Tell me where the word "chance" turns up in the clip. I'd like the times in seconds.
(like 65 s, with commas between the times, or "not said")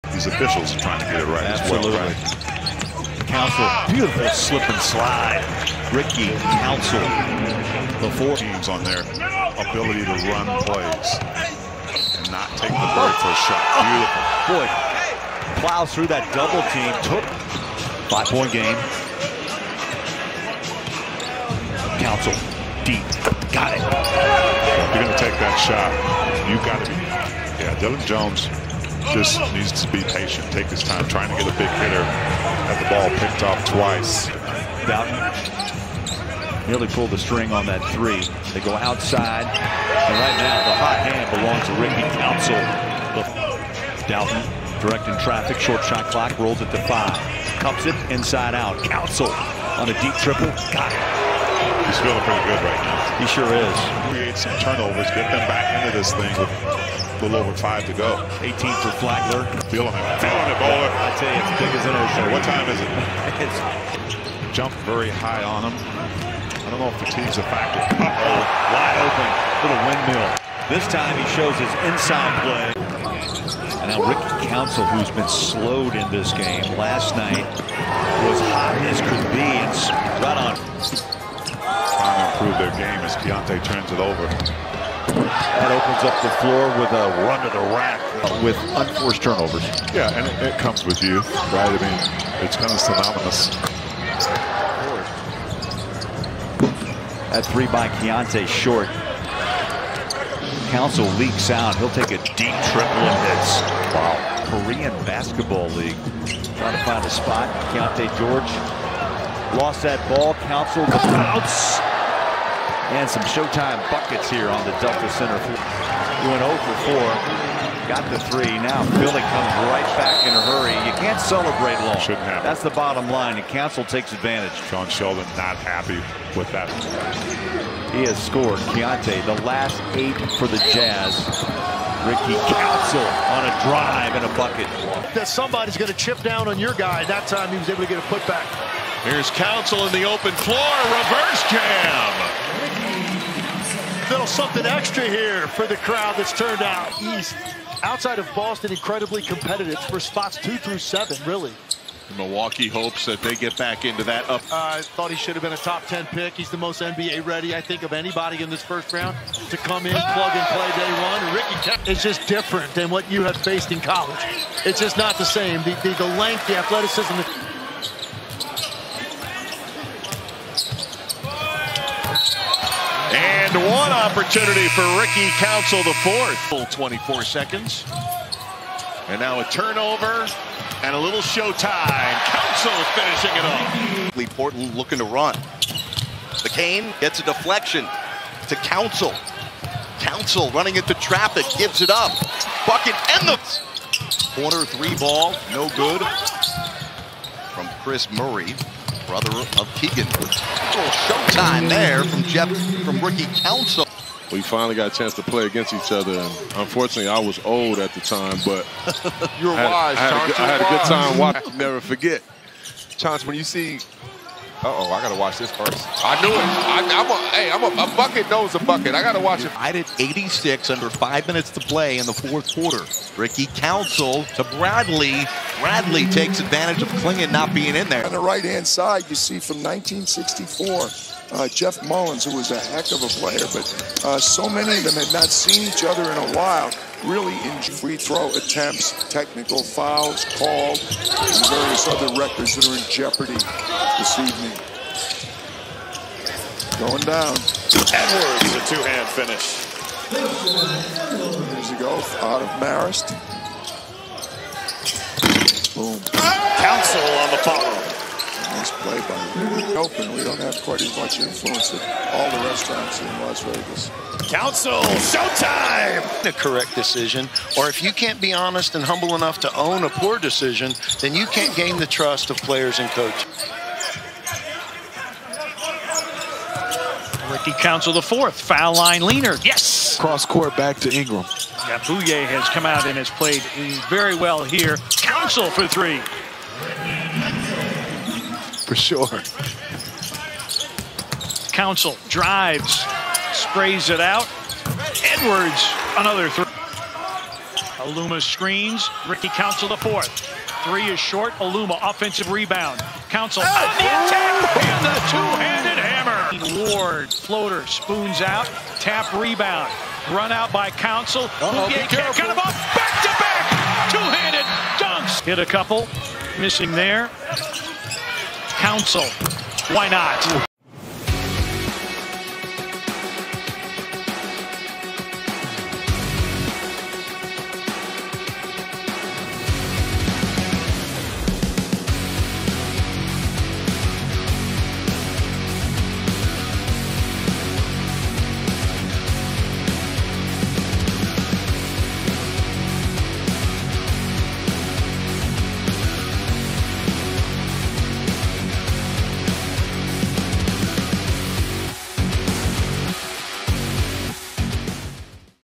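204 s, 212 s.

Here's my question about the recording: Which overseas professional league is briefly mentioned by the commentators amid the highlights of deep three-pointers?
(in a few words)
Korean Basketball League.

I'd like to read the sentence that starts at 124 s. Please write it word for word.
John Sheldon not happy with that.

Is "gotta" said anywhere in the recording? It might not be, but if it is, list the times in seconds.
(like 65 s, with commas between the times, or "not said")
215 s, 219 s.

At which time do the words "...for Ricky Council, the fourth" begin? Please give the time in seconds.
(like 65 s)
174 s.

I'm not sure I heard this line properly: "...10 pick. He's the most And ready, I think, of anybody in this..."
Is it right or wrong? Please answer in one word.
wrong.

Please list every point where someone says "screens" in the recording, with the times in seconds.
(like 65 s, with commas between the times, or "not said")
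298 s.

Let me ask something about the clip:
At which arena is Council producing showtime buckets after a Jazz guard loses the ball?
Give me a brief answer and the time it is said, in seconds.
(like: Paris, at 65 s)
Delta Center, at 114 s.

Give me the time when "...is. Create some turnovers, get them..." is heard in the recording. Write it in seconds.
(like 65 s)
53 s.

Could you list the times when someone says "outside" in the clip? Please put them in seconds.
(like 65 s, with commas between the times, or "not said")
38 s, 147 s.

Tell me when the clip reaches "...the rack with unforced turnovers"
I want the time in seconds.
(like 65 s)
87 s.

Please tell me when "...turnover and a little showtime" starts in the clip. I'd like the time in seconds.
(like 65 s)
179 s.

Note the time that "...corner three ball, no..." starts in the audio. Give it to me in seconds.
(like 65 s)
194 s.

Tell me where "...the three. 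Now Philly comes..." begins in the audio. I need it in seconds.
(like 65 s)
118 s.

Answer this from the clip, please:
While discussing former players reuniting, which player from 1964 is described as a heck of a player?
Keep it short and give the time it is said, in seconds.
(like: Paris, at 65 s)
Jeff Mullins, at 231 s.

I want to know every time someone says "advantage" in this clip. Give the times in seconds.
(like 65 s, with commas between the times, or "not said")
124 s, 226 s.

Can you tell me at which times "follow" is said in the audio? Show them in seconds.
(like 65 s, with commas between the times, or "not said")
257 s.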